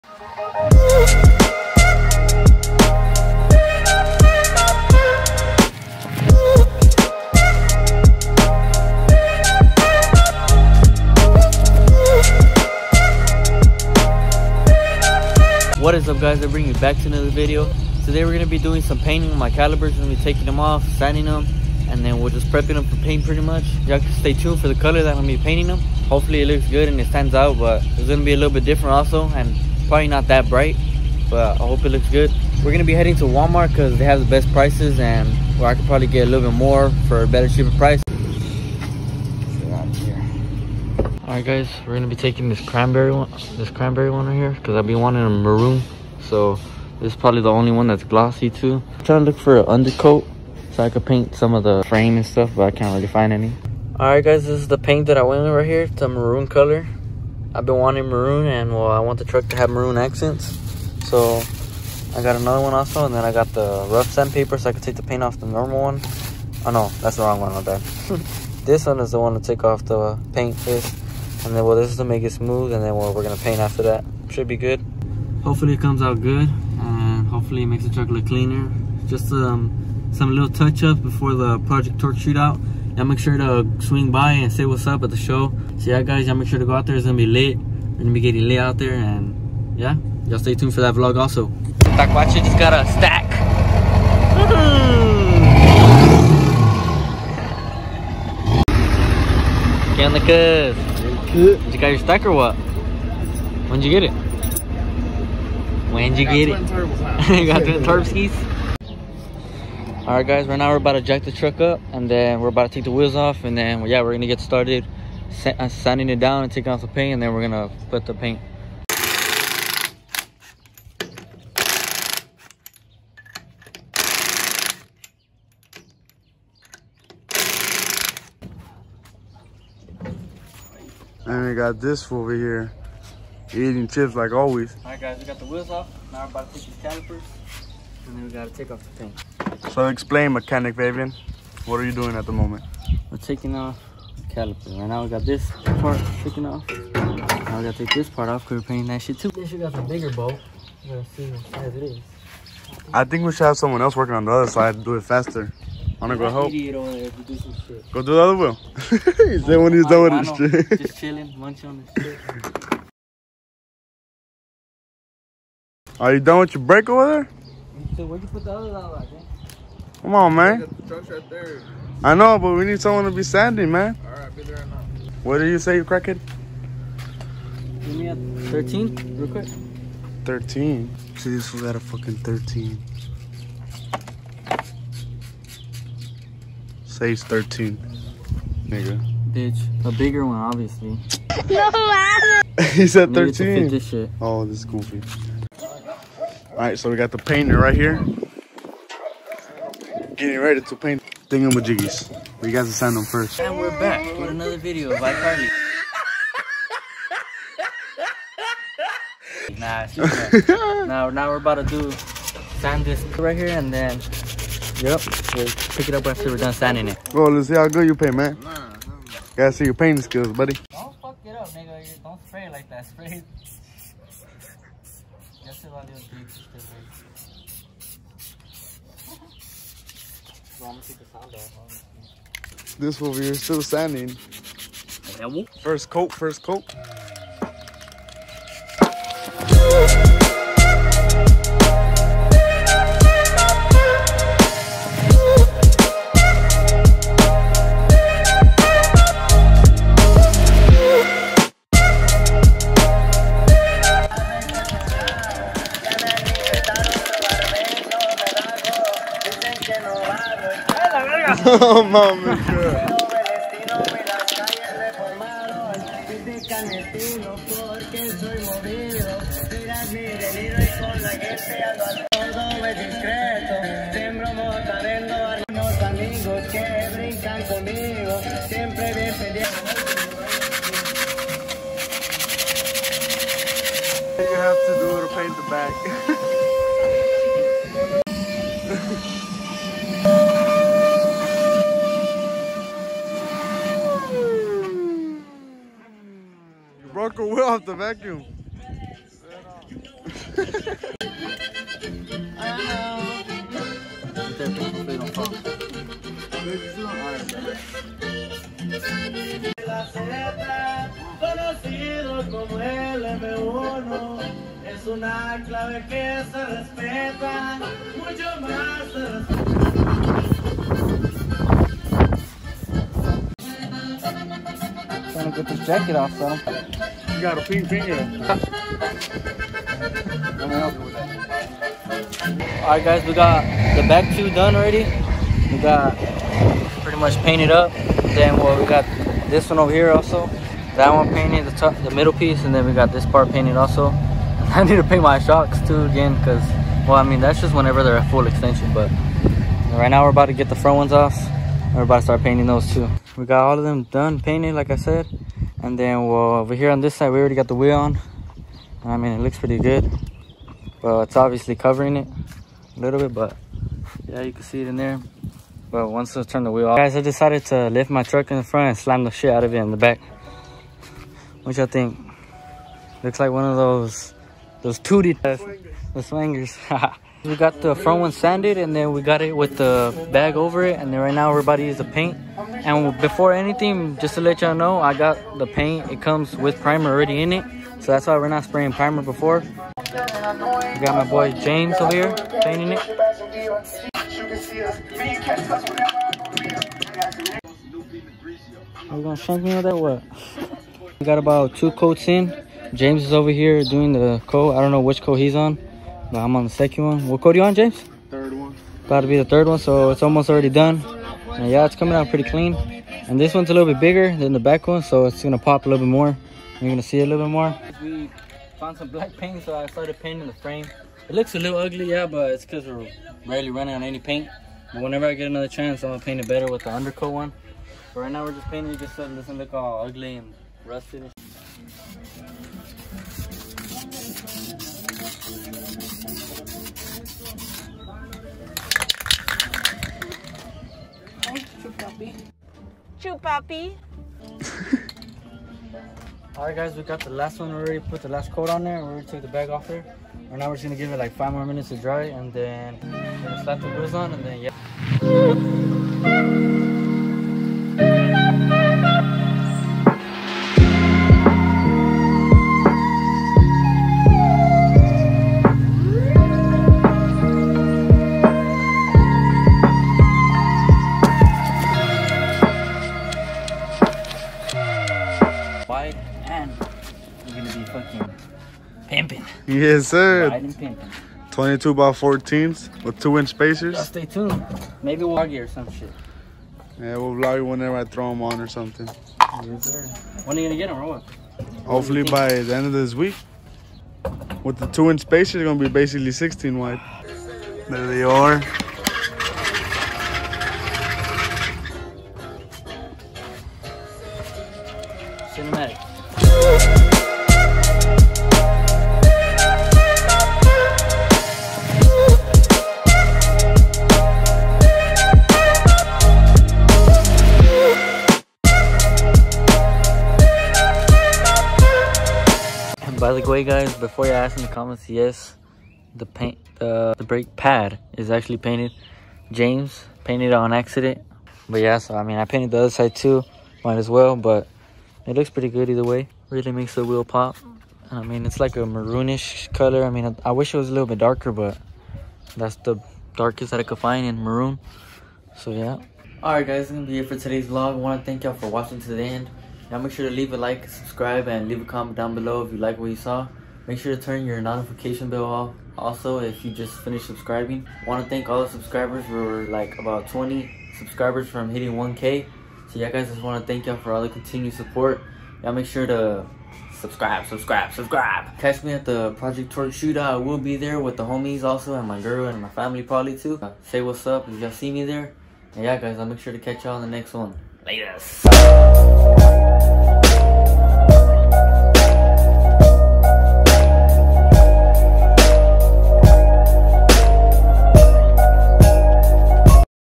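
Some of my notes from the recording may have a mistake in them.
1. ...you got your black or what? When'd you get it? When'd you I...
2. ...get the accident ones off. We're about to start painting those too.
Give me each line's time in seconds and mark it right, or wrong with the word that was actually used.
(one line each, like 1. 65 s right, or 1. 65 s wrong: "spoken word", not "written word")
1. 101 s wrong: "stack", not "black"
2. 350 s wrong: "front", not "accident".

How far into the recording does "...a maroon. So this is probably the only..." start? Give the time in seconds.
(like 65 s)
45 s.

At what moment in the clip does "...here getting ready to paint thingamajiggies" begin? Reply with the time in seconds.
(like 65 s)
197 s.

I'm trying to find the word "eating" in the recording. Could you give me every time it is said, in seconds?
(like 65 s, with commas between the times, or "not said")
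133 s.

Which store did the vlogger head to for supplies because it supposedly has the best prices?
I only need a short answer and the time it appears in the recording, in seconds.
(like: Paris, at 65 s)
Walmart, at 33 s.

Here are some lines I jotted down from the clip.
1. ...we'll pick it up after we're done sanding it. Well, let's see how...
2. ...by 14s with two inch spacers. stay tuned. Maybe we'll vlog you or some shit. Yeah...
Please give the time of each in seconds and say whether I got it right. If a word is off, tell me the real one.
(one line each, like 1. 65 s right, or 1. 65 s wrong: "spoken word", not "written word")
1. 215 s right
2. 481 s right.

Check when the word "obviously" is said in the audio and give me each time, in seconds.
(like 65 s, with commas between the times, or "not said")
190 s, 361 s.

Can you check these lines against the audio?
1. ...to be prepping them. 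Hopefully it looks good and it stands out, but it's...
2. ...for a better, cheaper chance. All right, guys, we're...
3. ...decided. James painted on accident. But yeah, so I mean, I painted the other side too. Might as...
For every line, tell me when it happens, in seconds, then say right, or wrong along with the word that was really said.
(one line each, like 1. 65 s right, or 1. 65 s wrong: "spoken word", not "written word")
1. 25 s wrong: "painting", not "prepping"
2. 37 s wrong: "price", not "chance"
3. 528 s wrong: "painted", not "decided".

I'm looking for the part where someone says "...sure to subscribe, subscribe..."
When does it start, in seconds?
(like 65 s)
565 s.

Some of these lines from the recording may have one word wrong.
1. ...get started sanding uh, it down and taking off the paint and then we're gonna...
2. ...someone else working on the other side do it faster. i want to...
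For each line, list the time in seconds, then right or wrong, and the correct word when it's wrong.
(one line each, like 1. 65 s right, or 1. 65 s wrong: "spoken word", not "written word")
1. 114 s right
2. 153 s right.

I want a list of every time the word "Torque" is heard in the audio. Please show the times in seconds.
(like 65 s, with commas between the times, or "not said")
81 s, 569 s.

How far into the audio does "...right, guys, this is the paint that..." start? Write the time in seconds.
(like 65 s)
54 s.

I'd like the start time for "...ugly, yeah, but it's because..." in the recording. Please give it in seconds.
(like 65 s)
421 s.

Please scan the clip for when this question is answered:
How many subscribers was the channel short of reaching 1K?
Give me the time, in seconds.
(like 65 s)
560 s.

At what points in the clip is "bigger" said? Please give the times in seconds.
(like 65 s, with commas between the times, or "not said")
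149 s, 189 s, 413 s.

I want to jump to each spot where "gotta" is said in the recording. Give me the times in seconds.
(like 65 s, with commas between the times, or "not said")
138 s, 147 s, 219 s.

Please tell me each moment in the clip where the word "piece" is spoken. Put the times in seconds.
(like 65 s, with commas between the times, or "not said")
342 s.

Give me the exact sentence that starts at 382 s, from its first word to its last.
And before anything, just to let y'all know, I got the paint.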